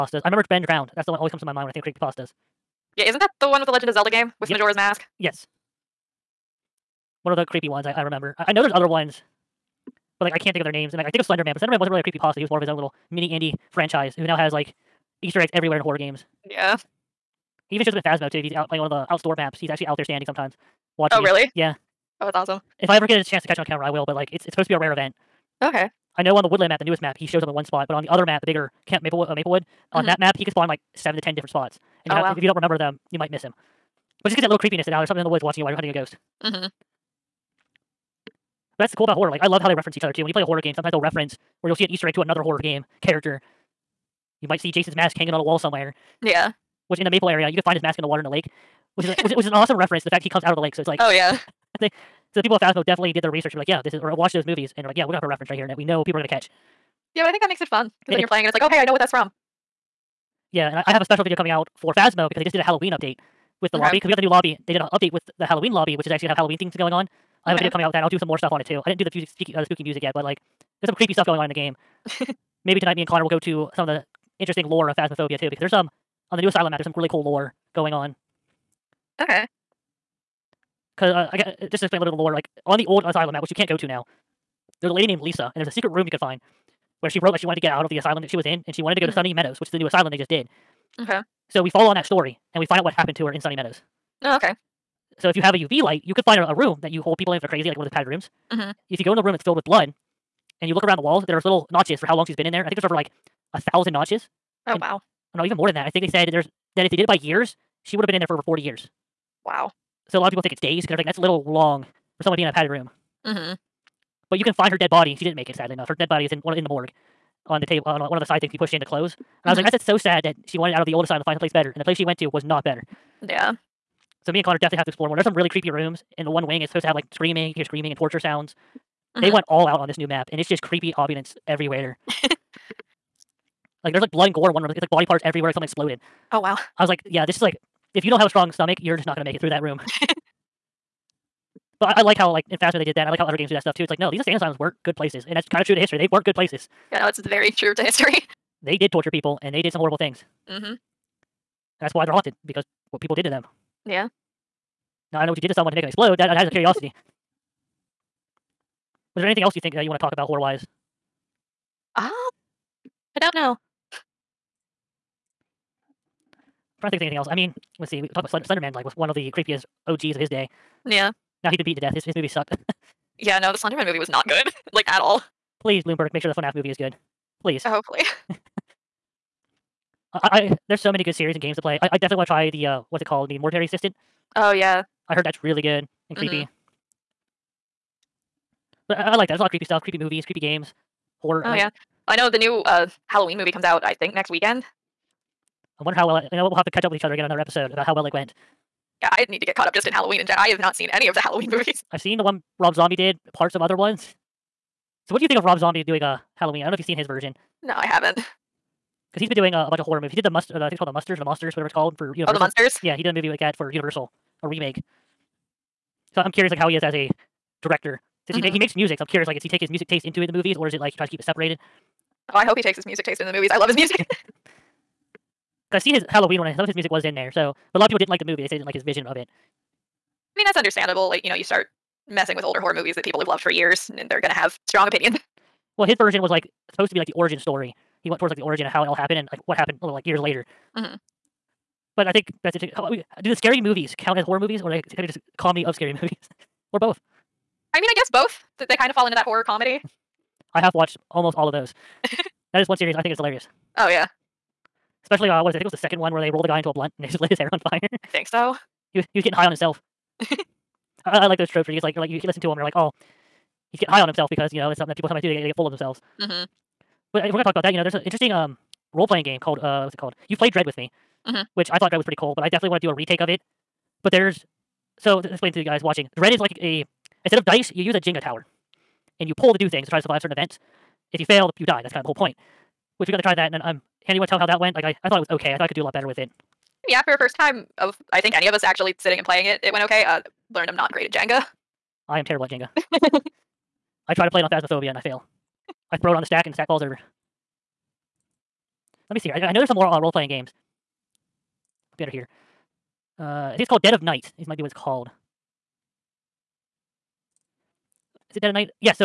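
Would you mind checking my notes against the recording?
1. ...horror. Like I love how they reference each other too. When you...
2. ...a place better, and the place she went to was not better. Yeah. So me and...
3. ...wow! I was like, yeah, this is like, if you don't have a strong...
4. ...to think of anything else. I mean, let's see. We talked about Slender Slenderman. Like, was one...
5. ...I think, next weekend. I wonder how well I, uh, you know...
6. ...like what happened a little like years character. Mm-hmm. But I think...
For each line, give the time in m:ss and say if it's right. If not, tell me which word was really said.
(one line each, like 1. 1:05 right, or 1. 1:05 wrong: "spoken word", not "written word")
1. 0:39 right
2. 2:01 right
3. 2:16 right
4. 2:46 right
5. 3:13 right
6. 3:59 wrong: "later", not "character".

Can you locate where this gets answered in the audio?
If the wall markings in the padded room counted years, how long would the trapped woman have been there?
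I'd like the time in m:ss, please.
1:48.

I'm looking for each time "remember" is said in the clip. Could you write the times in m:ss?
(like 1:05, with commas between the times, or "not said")
0:00, 0:08, 0:32.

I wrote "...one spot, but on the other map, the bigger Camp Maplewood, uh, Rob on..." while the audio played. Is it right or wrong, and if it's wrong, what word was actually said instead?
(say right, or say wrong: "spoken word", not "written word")
wrong: "Maplewood", not "Rob".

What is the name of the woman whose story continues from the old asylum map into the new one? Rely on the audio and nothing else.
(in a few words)
Lisa.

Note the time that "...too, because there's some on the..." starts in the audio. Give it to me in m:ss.
1:15.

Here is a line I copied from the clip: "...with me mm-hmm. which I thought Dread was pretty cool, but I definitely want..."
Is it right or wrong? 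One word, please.
right.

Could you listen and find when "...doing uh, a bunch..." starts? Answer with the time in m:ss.
3:29.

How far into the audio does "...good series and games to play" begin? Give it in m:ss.
3:01.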